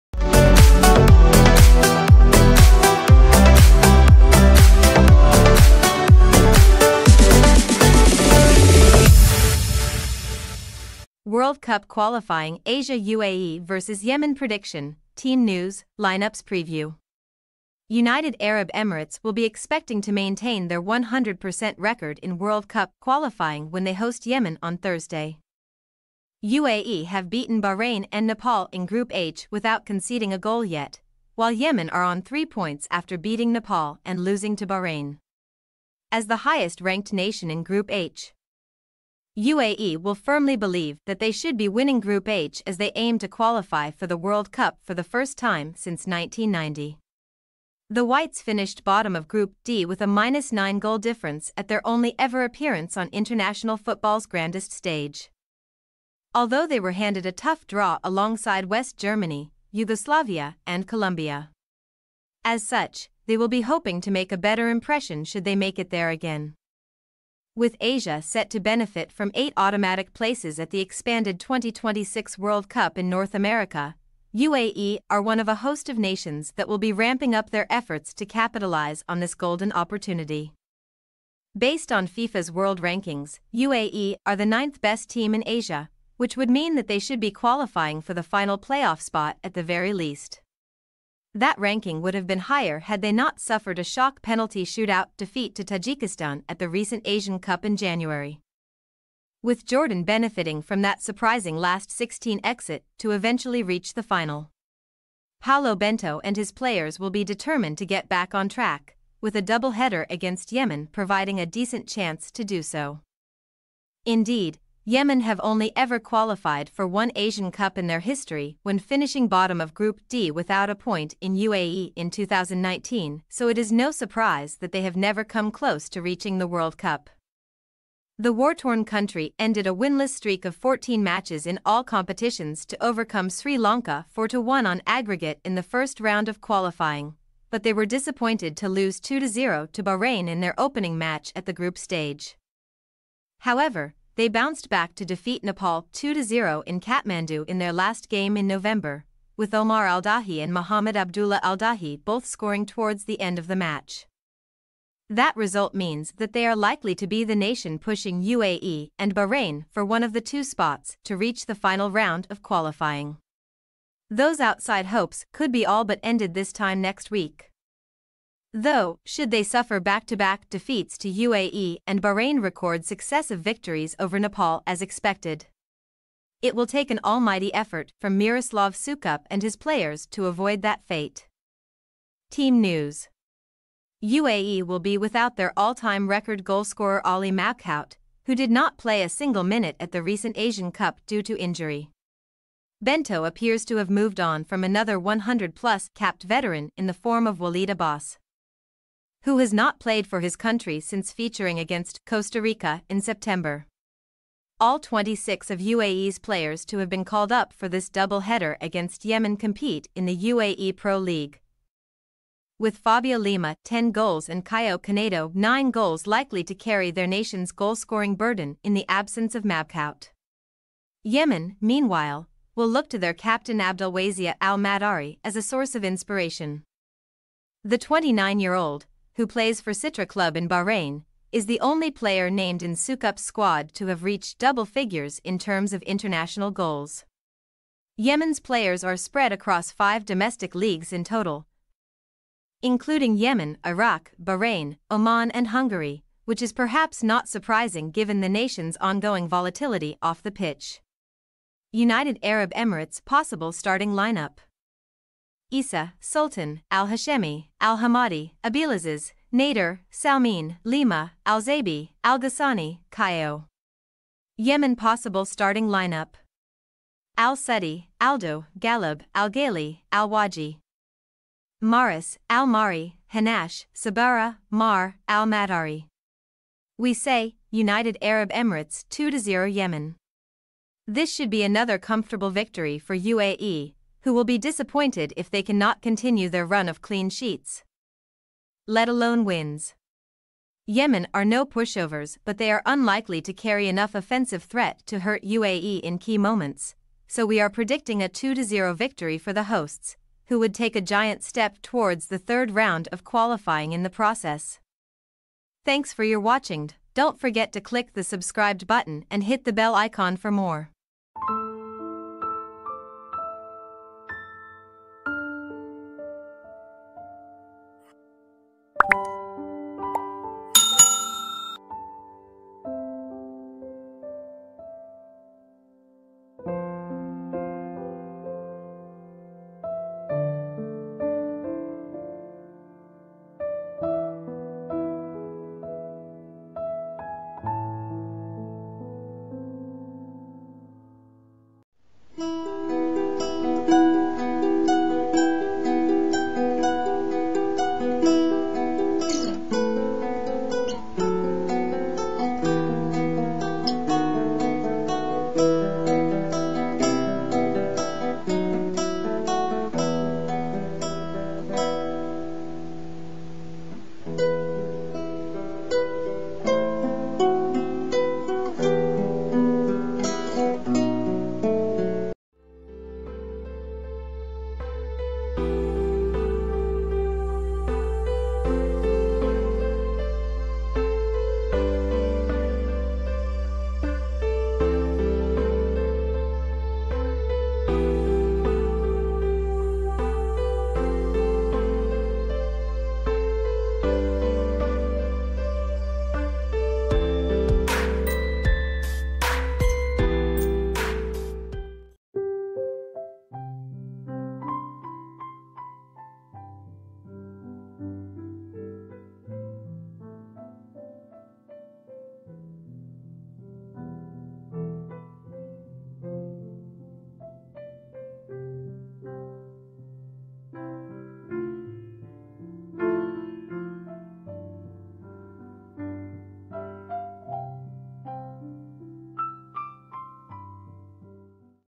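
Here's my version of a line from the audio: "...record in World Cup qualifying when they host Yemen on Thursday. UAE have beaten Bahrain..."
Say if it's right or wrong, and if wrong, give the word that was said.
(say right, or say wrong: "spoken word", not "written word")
right.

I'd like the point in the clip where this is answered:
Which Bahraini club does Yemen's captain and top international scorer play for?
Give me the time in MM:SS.
03:49.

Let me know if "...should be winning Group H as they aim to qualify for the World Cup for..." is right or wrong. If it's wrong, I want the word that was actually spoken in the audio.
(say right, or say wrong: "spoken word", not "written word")
right.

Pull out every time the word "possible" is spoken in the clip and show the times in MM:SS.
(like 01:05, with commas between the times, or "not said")
04:13, 04:24.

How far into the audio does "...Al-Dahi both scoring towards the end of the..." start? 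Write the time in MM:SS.
02:31.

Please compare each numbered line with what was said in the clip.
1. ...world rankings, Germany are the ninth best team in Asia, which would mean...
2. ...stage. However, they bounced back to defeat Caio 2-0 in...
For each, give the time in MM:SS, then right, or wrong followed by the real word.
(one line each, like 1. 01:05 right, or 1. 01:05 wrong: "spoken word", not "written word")
1. 01:22 wrong: "UAE", not "Germany"
2. 02:21 wrong: "Nepal", not "Caio".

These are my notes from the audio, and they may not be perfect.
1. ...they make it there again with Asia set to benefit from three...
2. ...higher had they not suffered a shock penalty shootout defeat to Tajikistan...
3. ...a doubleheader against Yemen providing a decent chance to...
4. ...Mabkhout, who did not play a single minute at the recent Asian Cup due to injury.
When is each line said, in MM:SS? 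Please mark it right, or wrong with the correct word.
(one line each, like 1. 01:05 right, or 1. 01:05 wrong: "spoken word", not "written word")
1. 01:05 wrong: "eight", not "three"
2. 01:32 right
3. 01:49 right
4. 03:07 right.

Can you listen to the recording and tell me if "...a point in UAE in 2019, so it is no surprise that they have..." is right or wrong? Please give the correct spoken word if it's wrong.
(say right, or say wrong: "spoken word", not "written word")
right.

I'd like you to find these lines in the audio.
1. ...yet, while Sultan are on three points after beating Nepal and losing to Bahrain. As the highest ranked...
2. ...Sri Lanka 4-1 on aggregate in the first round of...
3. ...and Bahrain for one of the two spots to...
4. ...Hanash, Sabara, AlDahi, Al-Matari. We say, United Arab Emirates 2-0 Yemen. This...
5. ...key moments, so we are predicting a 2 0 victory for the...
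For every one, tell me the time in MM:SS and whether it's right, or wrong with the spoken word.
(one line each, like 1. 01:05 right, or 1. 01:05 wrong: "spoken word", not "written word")
1. 00:30 wrong: "Yemen", not "Sultan"
2. 02:13 right
3. 02:38 right
4. 04:33 wrong: "Mar", not "AlDahi"
5. 04:55 right.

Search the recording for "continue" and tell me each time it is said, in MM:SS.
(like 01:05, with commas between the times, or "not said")
04:45.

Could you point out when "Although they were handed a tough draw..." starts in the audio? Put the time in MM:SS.
00:56.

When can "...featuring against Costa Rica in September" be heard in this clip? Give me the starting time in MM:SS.
03:21.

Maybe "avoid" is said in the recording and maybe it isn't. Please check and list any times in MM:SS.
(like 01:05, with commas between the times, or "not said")
03:00.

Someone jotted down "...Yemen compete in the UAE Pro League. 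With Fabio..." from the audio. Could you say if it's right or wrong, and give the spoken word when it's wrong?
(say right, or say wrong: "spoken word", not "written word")
right.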